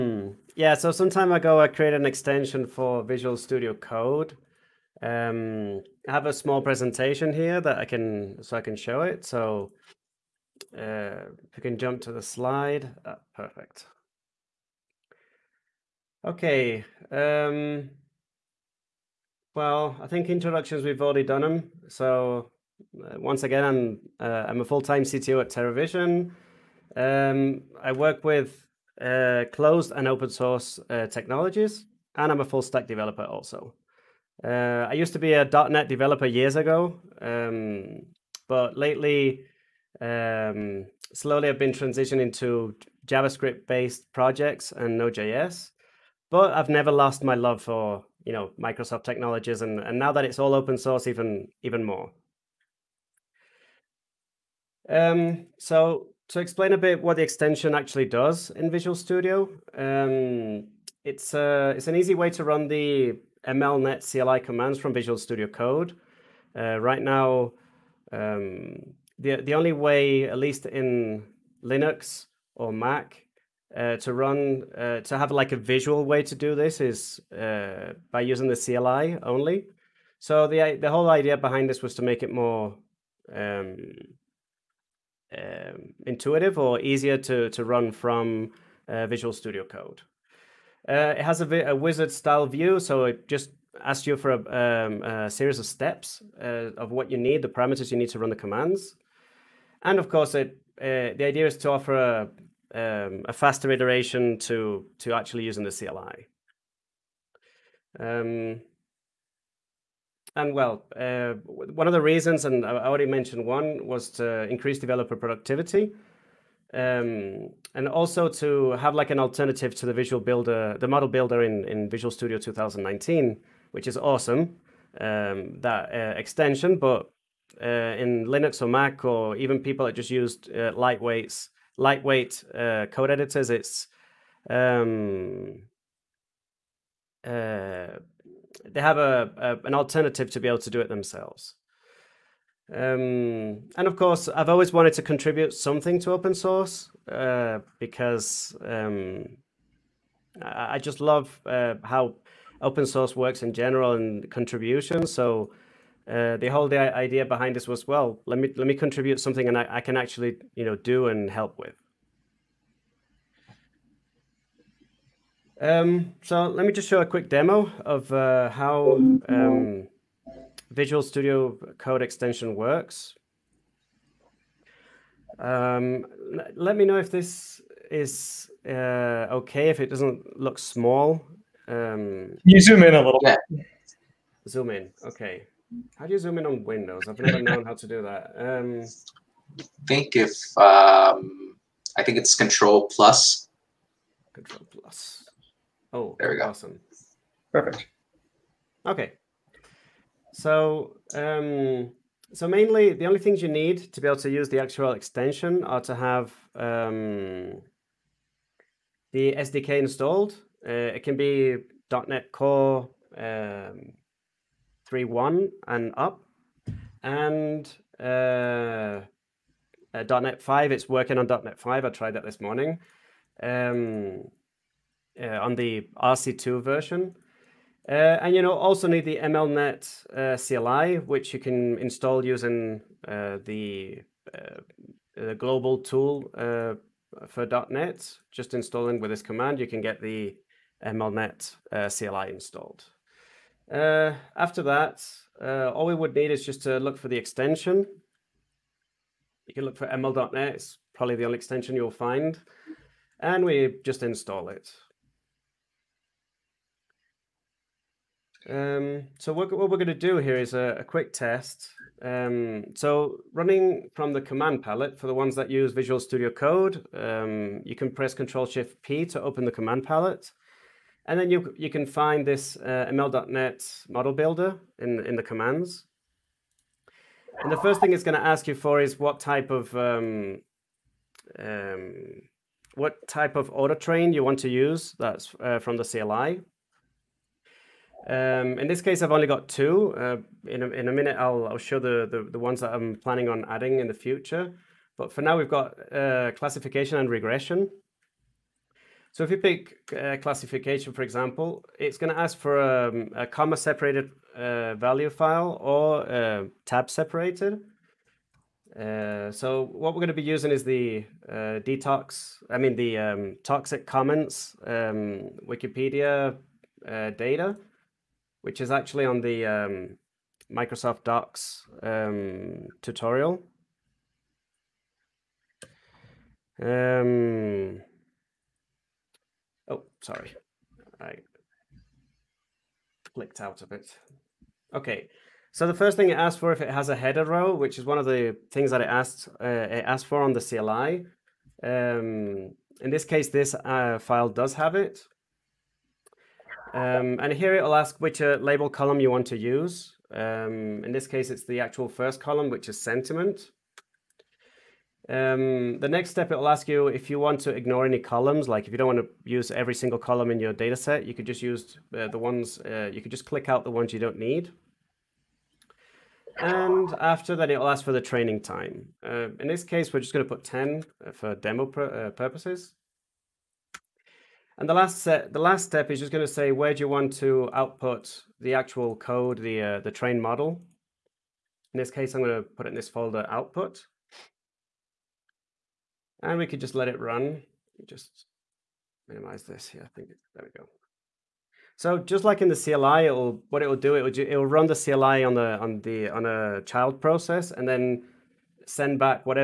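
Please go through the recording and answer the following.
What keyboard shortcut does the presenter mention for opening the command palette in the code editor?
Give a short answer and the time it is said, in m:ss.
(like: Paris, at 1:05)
Control Shift P, at 4:28.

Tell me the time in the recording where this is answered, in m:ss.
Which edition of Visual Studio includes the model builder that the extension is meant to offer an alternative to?
2:01.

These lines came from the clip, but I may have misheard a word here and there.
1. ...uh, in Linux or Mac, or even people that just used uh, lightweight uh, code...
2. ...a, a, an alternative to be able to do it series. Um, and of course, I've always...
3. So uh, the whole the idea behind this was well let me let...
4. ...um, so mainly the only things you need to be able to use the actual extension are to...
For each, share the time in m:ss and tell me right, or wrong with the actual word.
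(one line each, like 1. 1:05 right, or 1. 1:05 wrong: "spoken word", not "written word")
1. 2:07 right
2. 2:18 wrong: "themselves", not "series"
3. 2:35 right
4. 3:21 right.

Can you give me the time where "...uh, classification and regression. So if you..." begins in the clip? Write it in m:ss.
4:55.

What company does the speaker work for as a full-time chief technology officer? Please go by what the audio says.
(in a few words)
Teravision.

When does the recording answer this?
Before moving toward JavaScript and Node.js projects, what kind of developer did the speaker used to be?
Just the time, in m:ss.
0:35.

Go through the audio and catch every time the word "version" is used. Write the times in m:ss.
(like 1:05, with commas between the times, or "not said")
3:46.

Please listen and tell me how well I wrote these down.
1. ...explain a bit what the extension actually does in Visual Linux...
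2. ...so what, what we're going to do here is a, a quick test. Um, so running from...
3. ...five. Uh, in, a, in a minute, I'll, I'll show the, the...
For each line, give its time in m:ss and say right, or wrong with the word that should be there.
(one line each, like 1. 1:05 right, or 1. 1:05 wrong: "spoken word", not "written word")
1. 0:56 wrong: "Studio", not "Linux"
2. 4:19 right
3. 4:49 wrong: "two", not "five".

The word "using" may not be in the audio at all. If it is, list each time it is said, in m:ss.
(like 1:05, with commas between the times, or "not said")
1:18, 1:45, 3:52, 5:10.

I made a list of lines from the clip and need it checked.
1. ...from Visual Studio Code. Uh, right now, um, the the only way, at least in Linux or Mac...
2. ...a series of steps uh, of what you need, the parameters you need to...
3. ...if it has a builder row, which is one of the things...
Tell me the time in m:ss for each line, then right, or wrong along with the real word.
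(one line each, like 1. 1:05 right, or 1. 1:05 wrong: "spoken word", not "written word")
1. 1:04 right
2. 1:35 right
3. 5:36 wrong: "header", not "builder".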